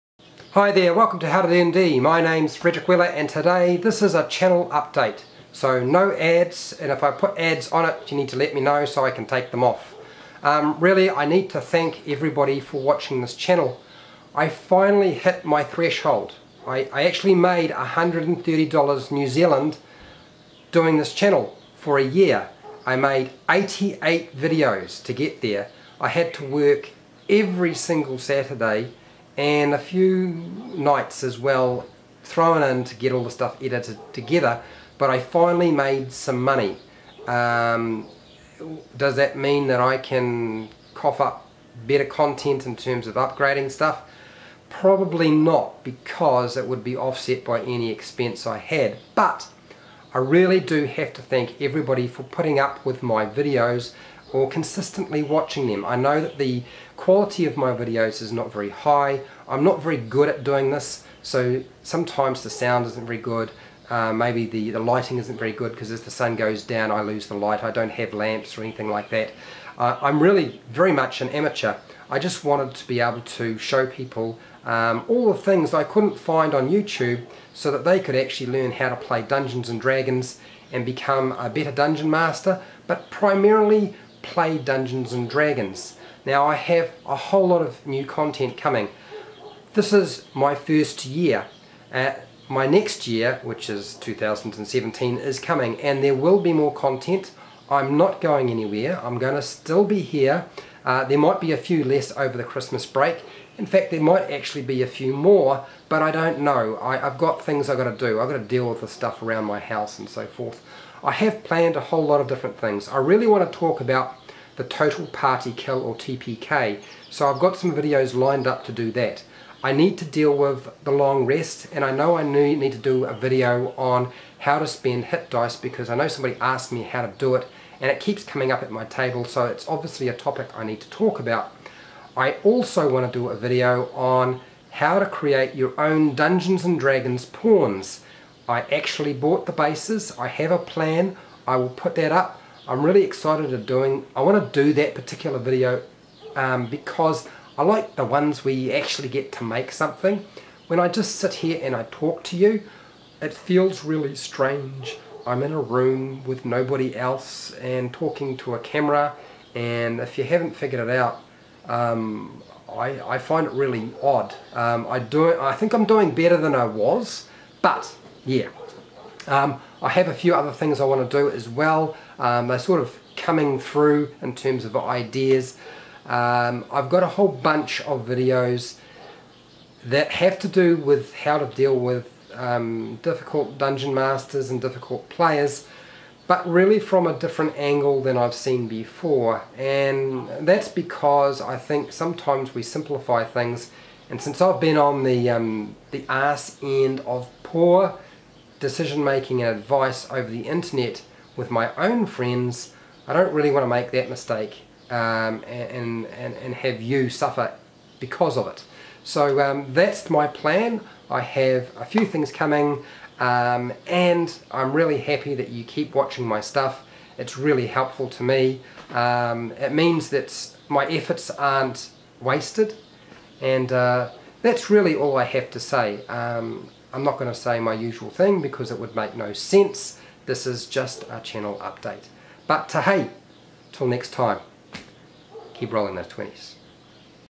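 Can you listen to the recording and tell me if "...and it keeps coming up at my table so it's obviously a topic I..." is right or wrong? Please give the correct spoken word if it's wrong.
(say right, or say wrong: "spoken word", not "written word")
right.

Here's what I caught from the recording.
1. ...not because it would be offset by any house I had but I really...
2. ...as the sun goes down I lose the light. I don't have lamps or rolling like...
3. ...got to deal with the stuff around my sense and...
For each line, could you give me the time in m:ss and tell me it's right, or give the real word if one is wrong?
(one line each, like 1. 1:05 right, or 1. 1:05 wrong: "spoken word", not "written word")
1. 0:45 wrong: "expense", not "house"
2. 1:05 wrong: "anything", not "rolling"
3. 1:48 wrong: "house", not "sense".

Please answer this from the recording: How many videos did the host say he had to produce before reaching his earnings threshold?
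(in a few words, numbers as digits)
88.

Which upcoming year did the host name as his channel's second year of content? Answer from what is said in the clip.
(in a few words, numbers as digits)
2017.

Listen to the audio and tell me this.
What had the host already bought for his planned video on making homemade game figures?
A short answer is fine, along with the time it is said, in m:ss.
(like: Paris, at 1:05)
the bases, at 2:19.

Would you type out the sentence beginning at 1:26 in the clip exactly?
Now I have a whole lot of new content coming.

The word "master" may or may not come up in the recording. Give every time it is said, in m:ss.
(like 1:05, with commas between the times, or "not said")
1:22, 3:03.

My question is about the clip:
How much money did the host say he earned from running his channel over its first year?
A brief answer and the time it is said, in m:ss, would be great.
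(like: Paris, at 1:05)
$130 New Zealand, at 0:17.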